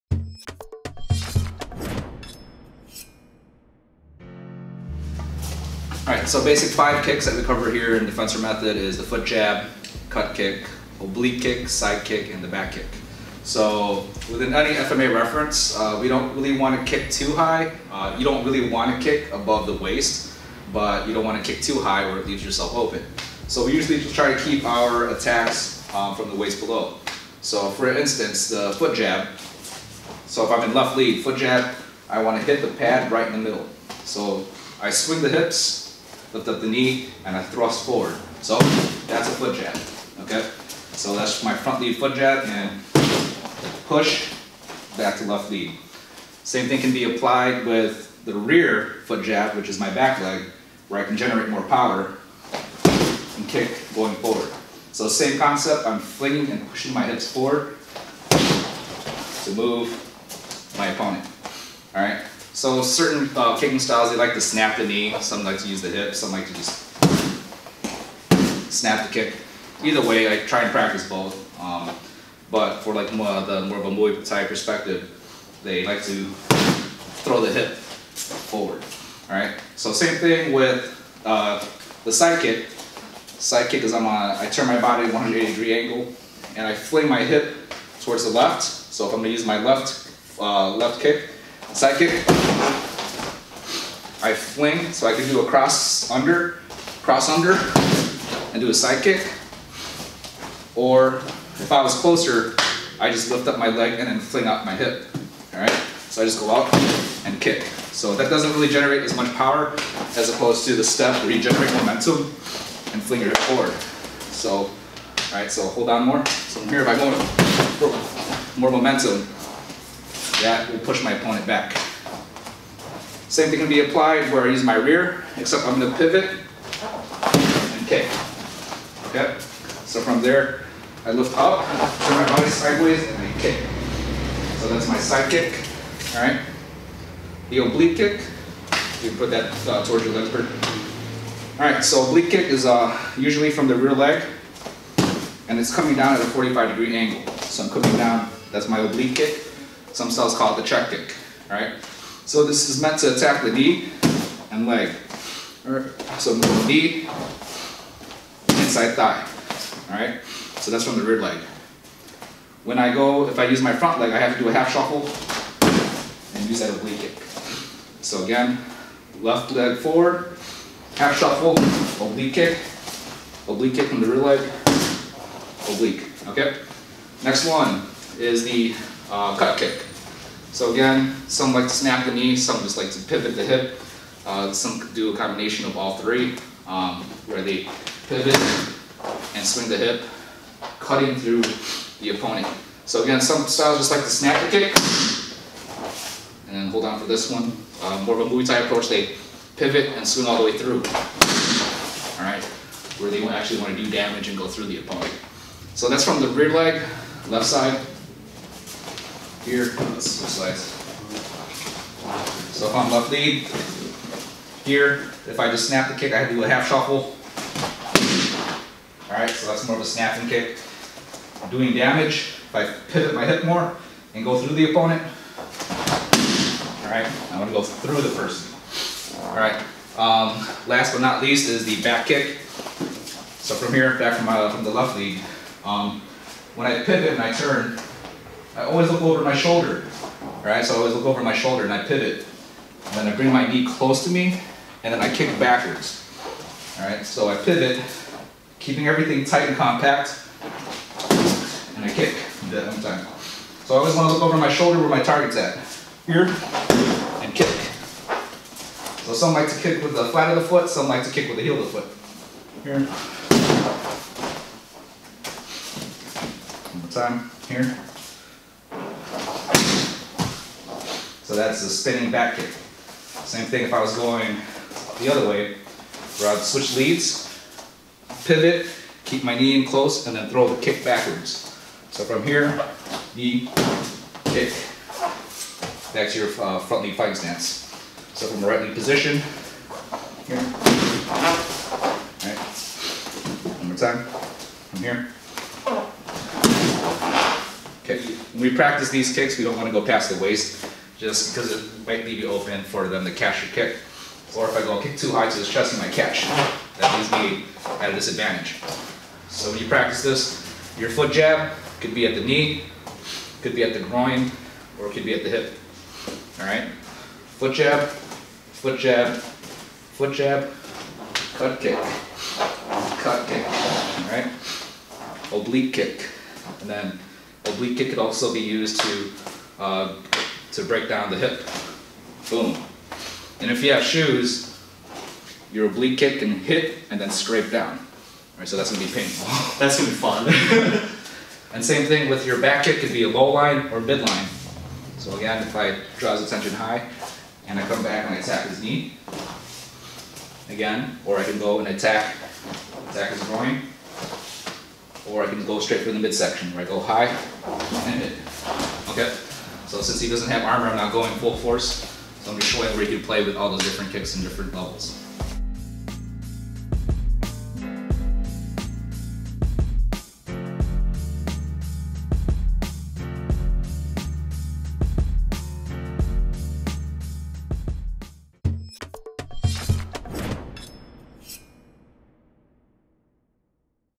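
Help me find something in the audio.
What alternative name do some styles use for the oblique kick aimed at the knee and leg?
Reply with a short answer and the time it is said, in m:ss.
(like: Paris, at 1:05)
check kick, at 2:30.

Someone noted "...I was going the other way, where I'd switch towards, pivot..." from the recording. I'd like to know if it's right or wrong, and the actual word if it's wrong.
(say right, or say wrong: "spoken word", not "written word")
wrong: "leads", not "towards".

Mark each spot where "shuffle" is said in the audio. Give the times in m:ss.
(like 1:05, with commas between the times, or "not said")
2:44, 2:51, 3:36.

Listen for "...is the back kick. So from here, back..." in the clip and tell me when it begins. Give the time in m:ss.
3:51.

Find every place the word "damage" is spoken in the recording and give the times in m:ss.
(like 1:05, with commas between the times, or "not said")
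3:23, 3:41.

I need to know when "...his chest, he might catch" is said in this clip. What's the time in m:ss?
5:05.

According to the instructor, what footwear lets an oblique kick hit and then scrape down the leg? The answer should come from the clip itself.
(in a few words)
shoes.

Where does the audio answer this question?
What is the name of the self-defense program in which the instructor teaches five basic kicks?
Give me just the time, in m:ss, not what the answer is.
0:08.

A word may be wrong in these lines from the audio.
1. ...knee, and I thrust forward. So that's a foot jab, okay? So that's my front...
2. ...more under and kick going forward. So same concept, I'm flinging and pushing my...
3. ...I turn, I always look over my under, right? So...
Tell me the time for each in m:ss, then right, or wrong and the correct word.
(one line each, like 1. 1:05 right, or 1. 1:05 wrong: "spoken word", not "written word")
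1. 0:36 right
2. 0:51 wrong: "power", not "under"
3. 3:57 wrong: "shoulder", not "under".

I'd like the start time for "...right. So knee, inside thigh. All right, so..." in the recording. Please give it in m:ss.
2:35.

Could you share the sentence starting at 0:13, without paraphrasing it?
So within any FMA reference, uh, we don't really want to kick too high.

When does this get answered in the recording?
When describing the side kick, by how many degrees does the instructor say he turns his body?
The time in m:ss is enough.
1:25.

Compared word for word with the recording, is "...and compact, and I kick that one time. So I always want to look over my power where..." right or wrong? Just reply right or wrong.
wrong.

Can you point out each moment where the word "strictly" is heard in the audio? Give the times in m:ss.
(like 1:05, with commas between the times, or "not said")
not said.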